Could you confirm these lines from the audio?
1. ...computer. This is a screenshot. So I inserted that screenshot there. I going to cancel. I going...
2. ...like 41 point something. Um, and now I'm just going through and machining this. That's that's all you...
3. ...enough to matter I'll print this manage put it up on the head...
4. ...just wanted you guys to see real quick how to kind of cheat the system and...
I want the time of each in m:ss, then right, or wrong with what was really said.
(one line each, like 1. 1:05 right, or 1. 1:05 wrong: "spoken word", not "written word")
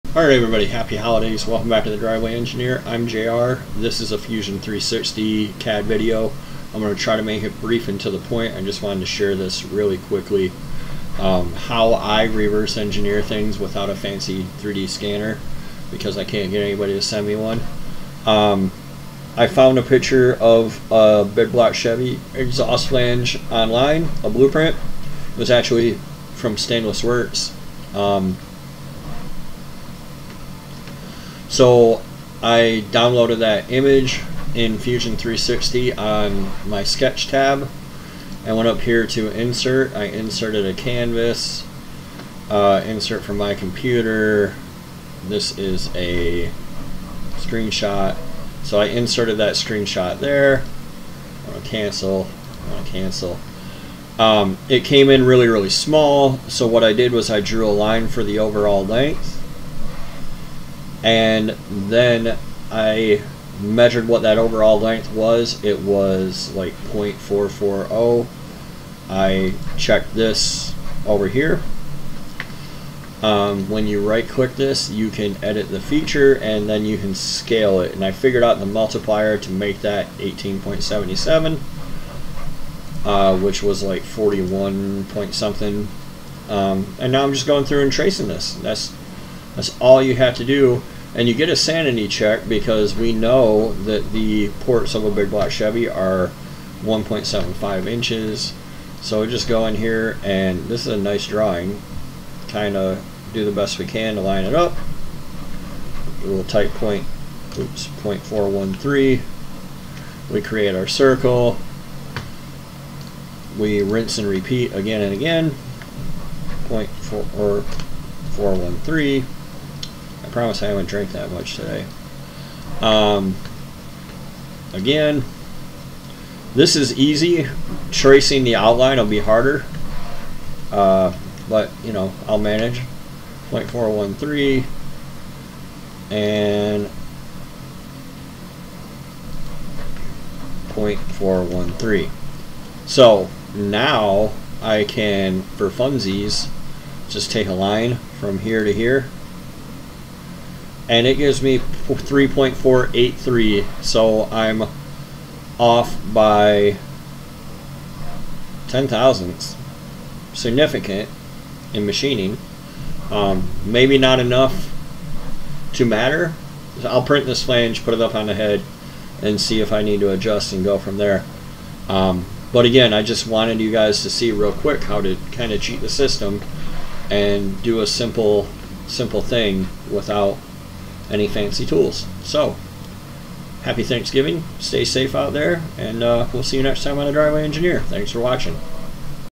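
1. 0:43 right
2. 1:23 wrong: "tracing", not "machining"
3. 2:44 wrong: "flange", not "manage"
4. 2:53 right.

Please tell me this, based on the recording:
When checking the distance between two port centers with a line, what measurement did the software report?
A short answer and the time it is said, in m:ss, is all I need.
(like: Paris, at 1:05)
3.483, at 2:31.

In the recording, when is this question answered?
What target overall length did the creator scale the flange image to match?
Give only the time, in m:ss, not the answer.
1:20.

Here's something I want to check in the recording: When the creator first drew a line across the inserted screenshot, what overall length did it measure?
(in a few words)
0.440.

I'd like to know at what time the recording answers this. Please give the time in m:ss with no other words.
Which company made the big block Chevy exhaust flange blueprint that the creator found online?
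0:26.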